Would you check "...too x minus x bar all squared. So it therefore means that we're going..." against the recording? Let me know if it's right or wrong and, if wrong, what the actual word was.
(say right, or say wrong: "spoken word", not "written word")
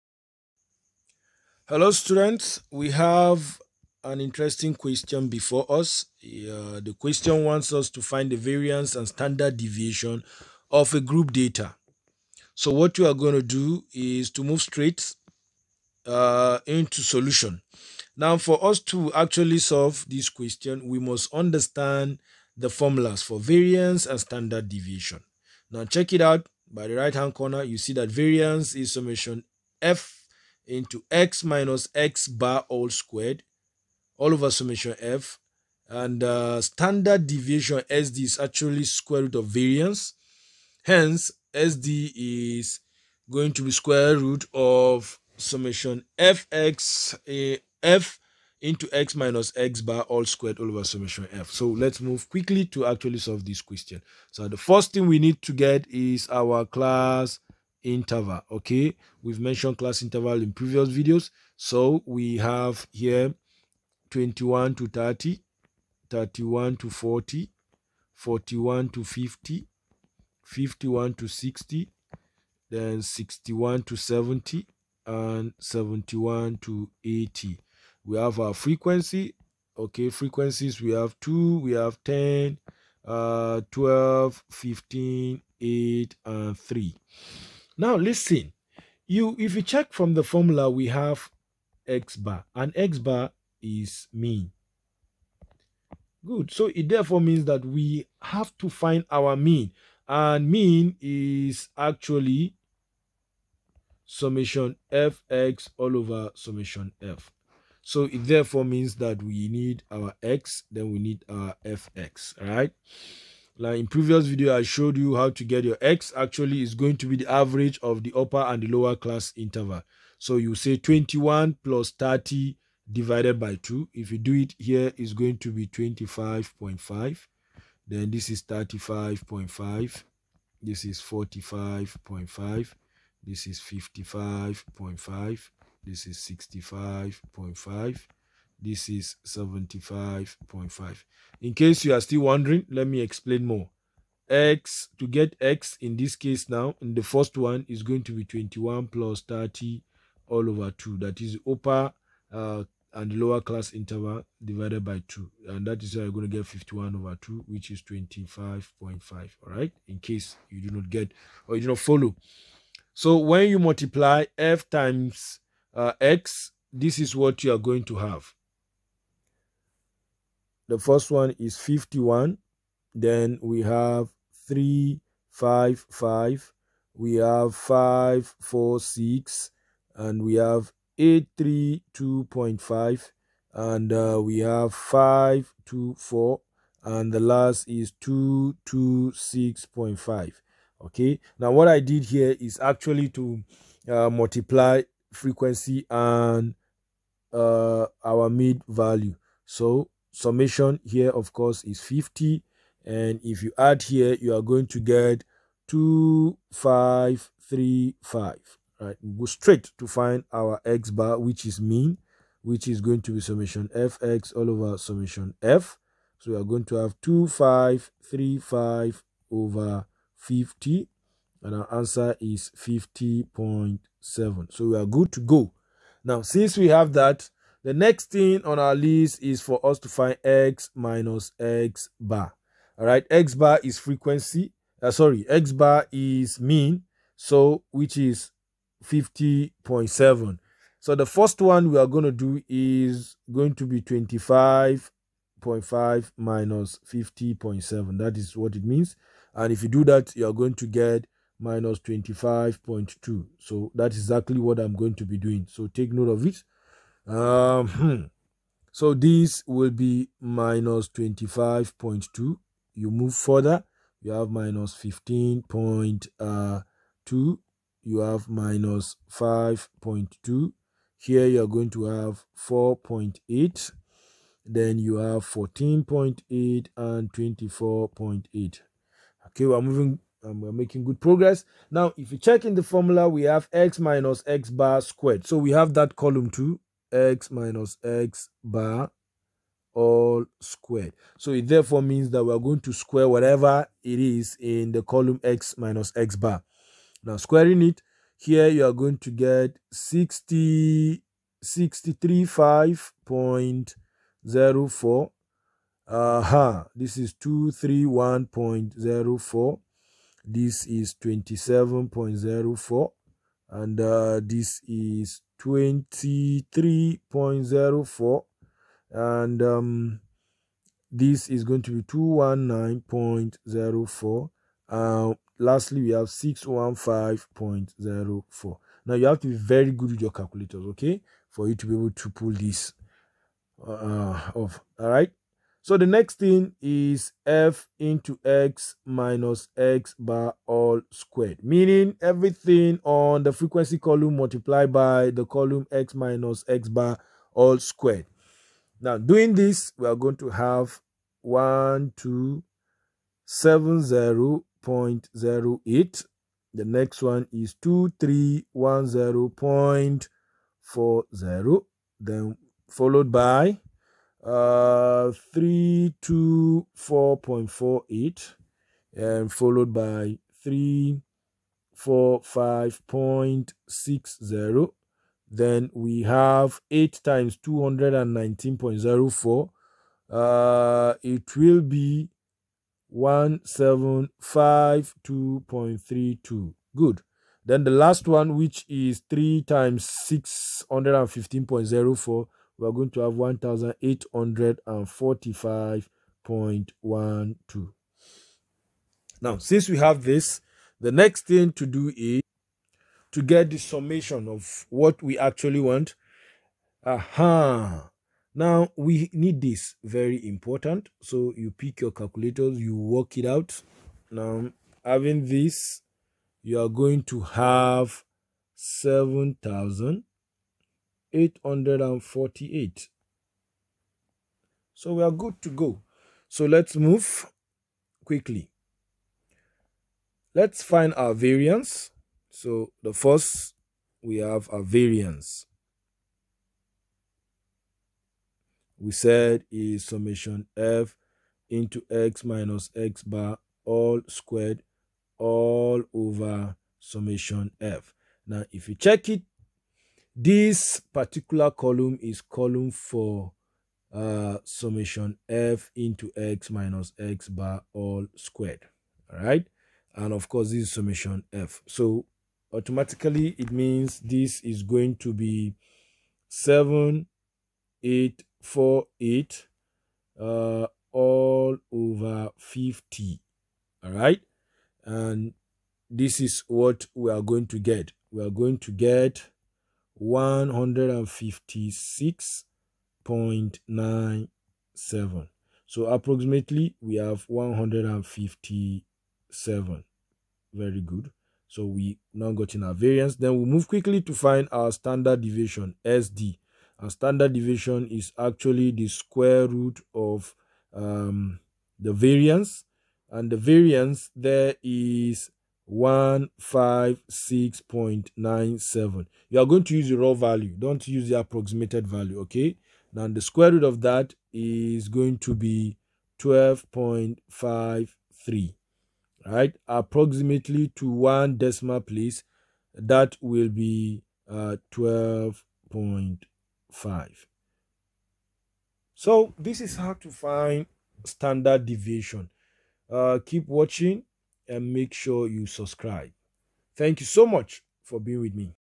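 right.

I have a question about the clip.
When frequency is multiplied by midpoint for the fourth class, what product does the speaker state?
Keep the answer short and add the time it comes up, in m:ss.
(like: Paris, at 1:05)
832.5, at 3:00.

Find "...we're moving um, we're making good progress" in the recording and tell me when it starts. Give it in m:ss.
4:39.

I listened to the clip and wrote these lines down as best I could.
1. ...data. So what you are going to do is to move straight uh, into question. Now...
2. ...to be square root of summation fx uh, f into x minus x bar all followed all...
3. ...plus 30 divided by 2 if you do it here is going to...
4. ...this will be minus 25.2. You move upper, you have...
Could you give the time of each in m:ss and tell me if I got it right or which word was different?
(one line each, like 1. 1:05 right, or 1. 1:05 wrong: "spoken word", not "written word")
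1. 0:11 wrong: "solution", not "question"
2. 0:43 wrong: "squared", not "followed"
3. 2:01 right
4. 4:18 wrong: "further", not "upper".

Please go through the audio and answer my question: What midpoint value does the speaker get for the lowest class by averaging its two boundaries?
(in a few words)
25.5.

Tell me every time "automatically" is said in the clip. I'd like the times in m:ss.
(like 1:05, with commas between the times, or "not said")
7:42.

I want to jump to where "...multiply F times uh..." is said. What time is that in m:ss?
2:43.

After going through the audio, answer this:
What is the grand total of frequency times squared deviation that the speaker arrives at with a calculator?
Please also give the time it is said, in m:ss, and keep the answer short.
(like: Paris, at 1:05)
7848, at 6:58.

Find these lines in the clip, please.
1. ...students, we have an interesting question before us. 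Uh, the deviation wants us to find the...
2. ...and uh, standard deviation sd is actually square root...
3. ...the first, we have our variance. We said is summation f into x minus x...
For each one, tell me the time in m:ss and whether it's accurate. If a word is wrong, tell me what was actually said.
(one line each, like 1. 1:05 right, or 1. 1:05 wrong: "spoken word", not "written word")
1. 0:01 wrong: "question", not "deviation"
2. 0:35 right
3. 7:12 right.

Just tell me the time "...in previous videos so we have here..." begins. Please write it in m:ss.
1:00.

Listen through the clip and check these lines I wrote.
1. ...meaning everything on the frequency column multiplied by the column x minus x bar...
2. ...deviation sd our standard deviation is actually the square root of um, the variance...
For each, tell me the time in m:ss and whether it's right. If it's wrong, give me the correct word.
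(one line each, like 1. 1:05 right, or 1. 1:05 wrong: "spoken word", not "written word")
1. 5:41 right
2. 8:15 right.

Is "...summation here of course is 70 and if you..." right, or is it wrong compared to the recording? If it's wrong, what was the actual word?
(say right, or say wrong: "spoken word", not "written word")
wrong: "50", not "70".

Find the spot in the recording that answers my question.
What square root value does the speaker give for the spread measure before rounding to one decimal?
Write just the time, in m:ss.
8:36.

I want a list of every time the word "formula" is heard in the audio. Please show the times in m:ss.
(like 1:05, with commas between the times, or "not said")
0:22, 1:30, 4:42.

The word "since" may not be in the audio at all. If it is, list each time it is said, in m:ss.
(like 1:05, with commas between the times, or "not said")
3:46, 6:39.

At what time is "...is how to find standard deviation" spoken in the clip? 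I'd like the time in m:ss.
8:49.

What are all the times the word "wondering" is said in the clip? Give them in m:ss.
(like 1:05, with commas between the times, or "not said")
2:22.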